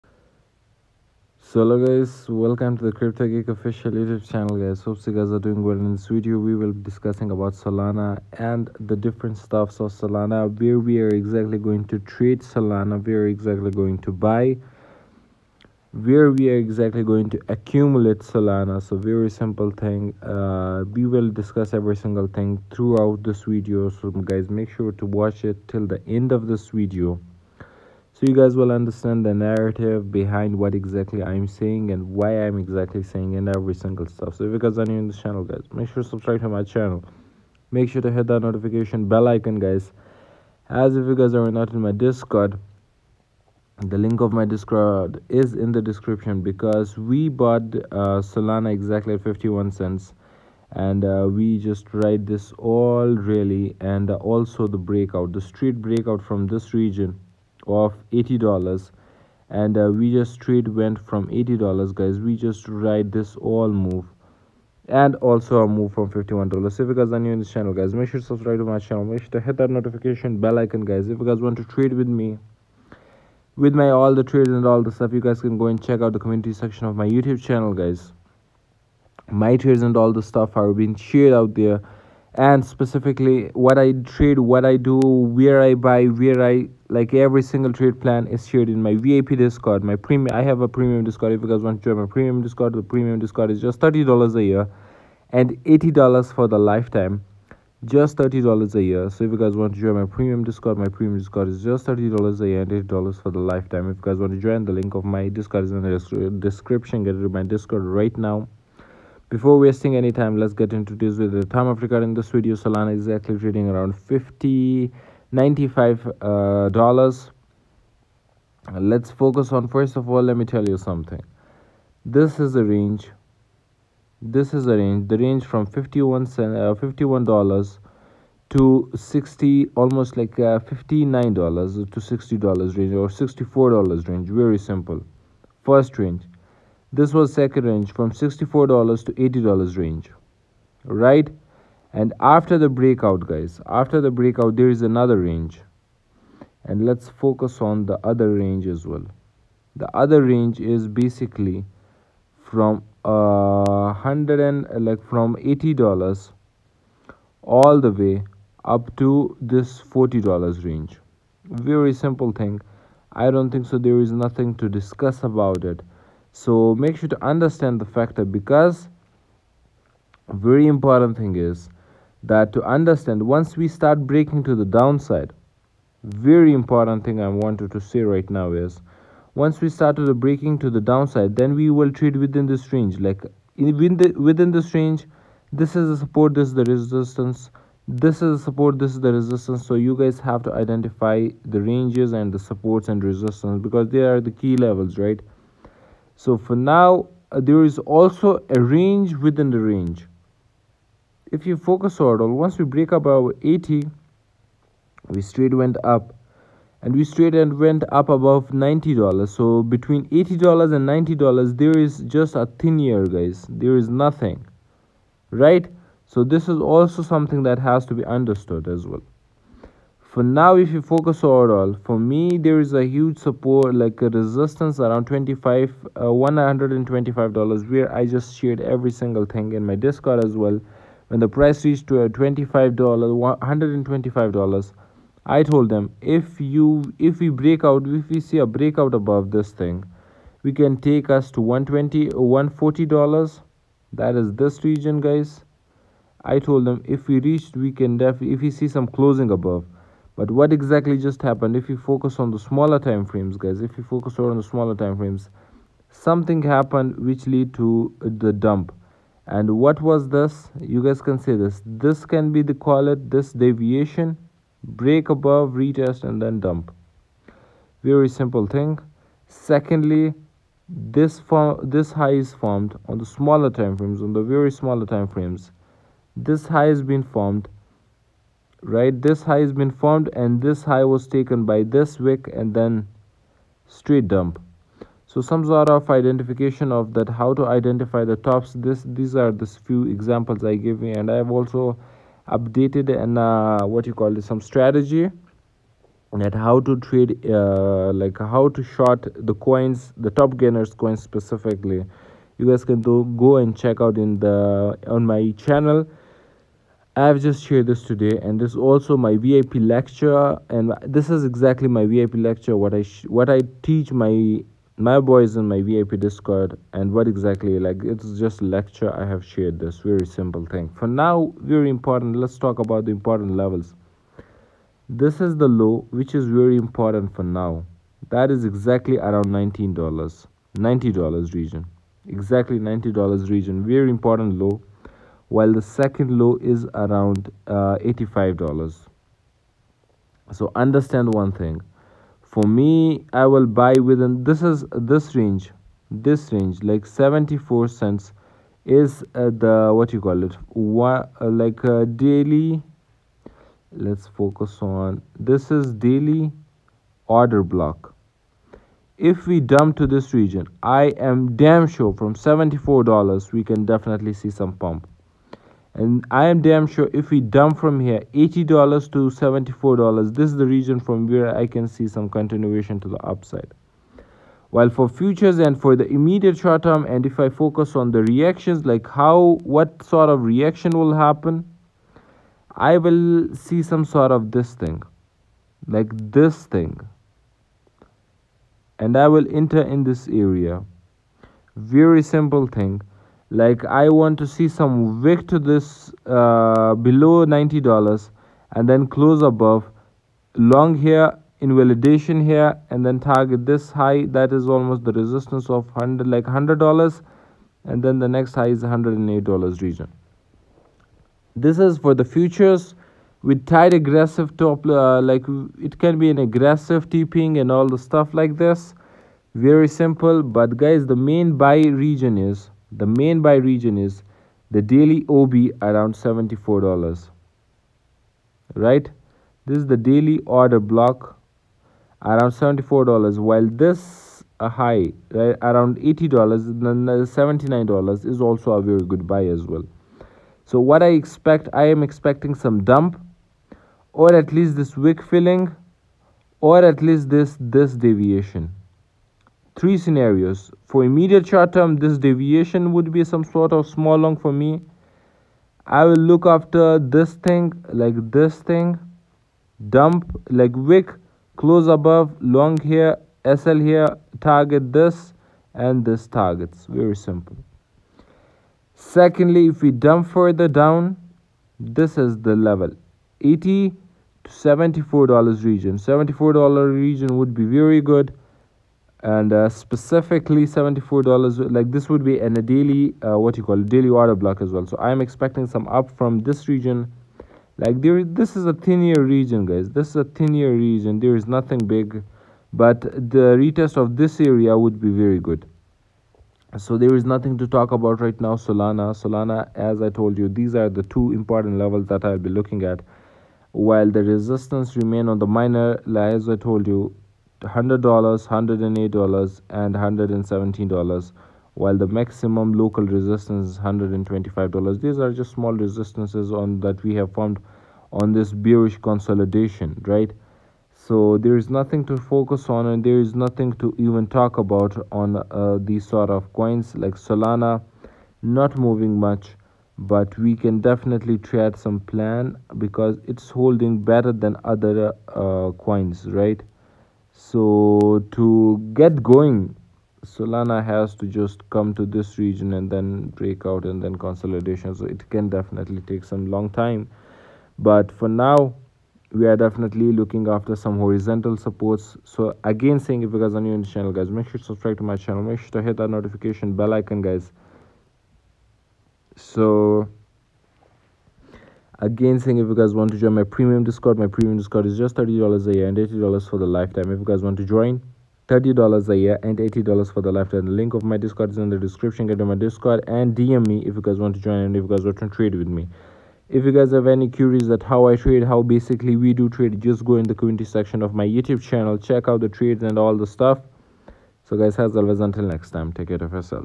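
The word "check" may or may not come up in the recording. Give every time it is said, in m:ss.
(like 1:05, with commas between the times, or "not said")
1:15, 5:03, 9:41.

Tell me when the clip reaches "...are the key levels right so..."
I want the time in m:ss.
3:13.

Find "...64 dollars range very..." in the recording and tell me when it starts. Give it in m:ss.
2:13.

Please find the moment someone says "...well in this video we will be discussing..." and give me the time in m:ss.
0:05.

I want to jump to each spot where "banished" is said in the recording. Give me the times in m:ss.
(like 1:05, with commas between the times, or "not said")
not said.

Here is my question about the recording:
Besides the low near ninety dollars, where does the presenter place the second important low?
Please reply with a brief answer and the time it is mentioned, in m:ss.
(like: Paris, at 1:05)
$85, at 5:37.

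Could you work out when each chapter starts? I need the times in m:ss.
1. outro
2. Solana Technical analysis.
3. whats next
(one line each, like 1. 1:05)
1. 7:50
2. 1:30
3. 5:40.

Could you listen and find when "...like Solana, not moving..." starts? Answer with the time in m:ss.
8:46.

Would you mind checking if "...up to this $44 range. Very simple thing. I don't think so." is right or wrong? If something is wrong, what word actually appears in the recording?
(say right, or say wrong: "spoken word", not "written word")
wrong: "40", not "44".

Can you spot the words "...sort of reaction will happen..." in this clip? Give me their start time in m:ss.
6:19.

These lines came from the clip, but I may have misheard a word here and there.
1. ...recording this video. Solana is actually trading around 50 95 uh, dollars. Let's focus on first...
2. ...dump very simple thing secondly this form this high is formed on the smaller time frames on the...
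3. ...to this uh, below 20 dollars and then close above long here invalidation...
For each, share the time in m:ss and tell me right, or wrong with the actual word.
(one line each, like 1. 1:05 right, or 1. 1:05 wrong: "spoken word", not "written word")
1. 1:51 right
2. 4:26 right
3. 6:35 wrong: "90", not "20".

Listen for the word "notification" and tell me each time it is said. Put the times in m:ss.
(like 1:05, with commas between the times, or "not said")
0:38, 1:09, 9:15.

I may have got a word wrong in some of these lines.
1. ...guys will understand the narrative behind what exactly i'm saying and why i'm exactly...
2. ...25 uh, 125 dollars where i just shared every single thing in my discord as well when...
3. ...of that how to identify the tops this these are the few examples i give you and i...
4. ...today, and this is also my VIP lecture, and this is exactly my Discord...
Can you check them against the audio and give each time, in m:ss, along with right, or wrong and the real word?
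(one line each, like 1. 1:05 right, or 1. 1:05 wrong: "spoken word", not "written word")
1. 0:28 right
2. 3:45 right
3. 4:46 right
4. 5:07 wrong: "VIP", not "Discord".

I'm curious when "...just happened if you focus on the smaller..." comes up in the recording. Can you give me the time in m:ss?
4:10.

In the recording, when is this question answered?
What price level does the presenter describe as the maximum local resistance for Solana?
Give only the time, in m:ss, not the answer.
8:31.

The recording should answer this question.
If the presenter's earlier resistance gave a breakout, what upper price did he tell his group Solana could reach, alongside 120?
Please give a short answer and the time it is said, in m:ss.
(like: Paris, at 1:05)
$140, at 4:02.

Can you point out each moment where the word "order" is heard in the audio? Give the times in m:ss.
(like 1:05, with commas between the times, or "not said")
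3:22, 5:57, 7:10, 8:03.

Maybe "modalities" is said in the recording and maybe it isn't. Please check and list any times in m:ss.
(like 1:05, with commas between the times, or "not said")
not said.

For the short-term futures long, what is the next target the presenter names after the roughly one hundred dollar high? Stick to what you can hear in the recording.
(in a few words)
$108.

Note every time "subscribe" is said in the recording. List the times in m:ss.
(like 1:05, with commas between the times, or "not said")
0:36, 1:08, 9:14.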